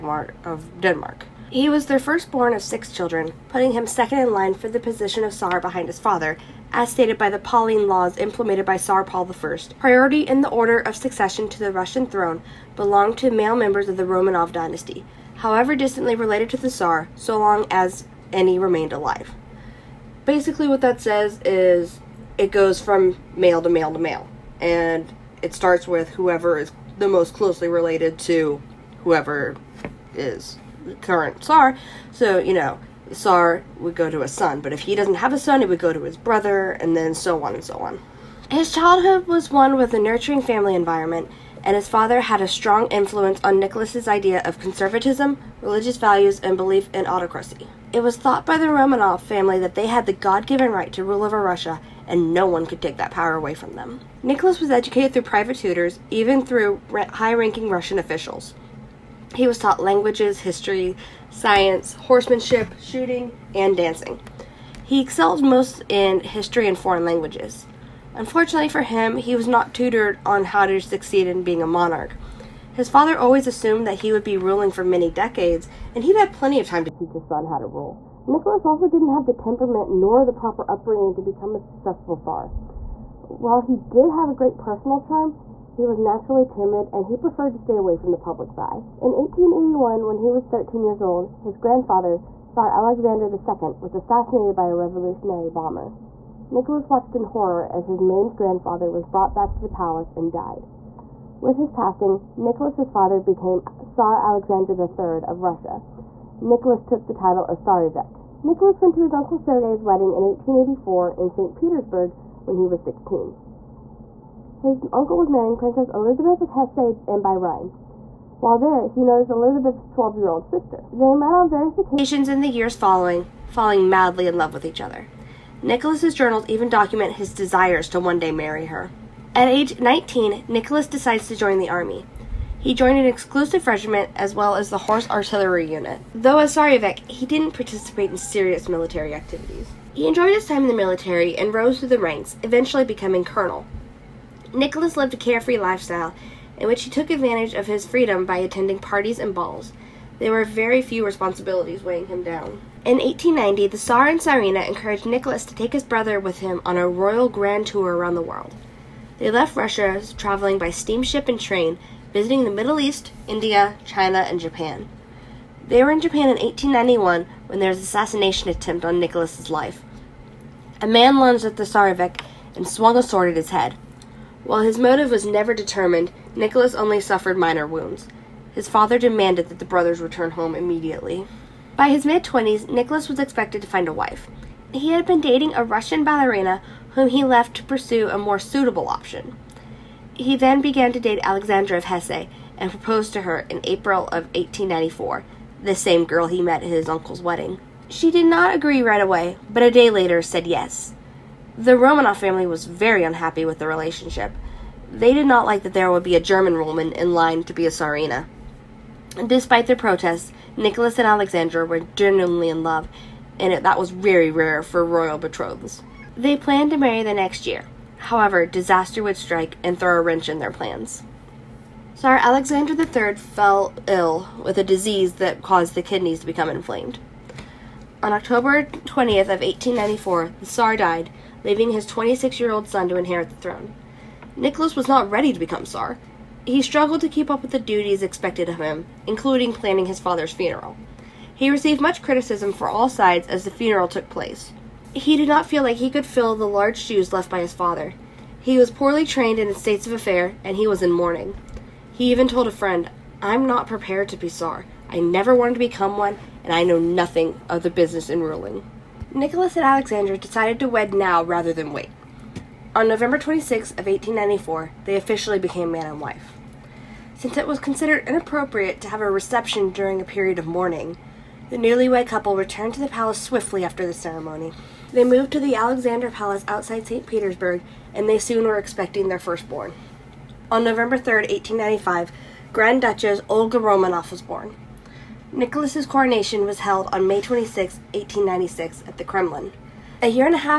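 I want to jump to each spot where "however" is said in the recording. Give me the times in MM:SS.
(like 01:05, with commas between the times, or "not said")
00:15, 03:37.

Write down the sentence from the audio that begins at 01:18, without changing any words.
Nicholas also didn't have the temperament nor the proper upbringing to become a successful Tsar.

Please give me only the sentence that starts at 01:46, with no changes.
Nicholas took the title of Tsarevich.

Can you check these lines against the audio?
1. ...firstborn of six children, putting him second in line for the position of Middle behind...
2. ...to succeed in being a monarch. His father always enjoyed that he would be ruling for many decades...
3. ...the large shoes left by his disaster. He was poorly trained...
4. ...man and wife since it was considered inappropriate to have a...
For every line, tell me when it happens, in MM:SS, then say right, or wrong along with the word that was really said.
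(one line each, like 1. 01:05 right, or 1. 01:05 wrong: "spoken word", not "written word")
1. 00:01 wrong: "Tsar", not "Middle"
2. 01:10 wrong: "assumed", not "enjoyed"
3. 04:06 wrong: "father", not "disaster"
4. 04:25 right.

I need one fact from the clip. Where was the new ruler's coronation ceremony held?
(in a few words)
The Kremlin.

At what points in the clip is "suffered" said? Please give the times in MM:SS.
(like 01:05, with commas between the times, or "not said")
02:57.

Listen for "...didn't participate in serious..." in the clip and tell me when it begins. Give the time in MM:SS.
02:17.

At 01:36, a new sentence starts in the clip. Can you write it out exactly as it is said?
Nicholas watched in horror as his maimed grandfather was brought back to the palace and died.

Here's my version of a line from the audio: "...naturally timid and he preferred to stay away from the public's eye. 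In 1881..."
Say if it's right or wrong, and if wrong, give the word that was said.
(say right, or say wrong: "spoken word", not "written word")
right.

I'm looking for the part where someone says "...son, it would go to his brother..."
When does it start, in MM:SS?
00:35.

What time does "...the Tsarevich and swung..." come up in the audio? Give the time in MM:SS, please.
02:51.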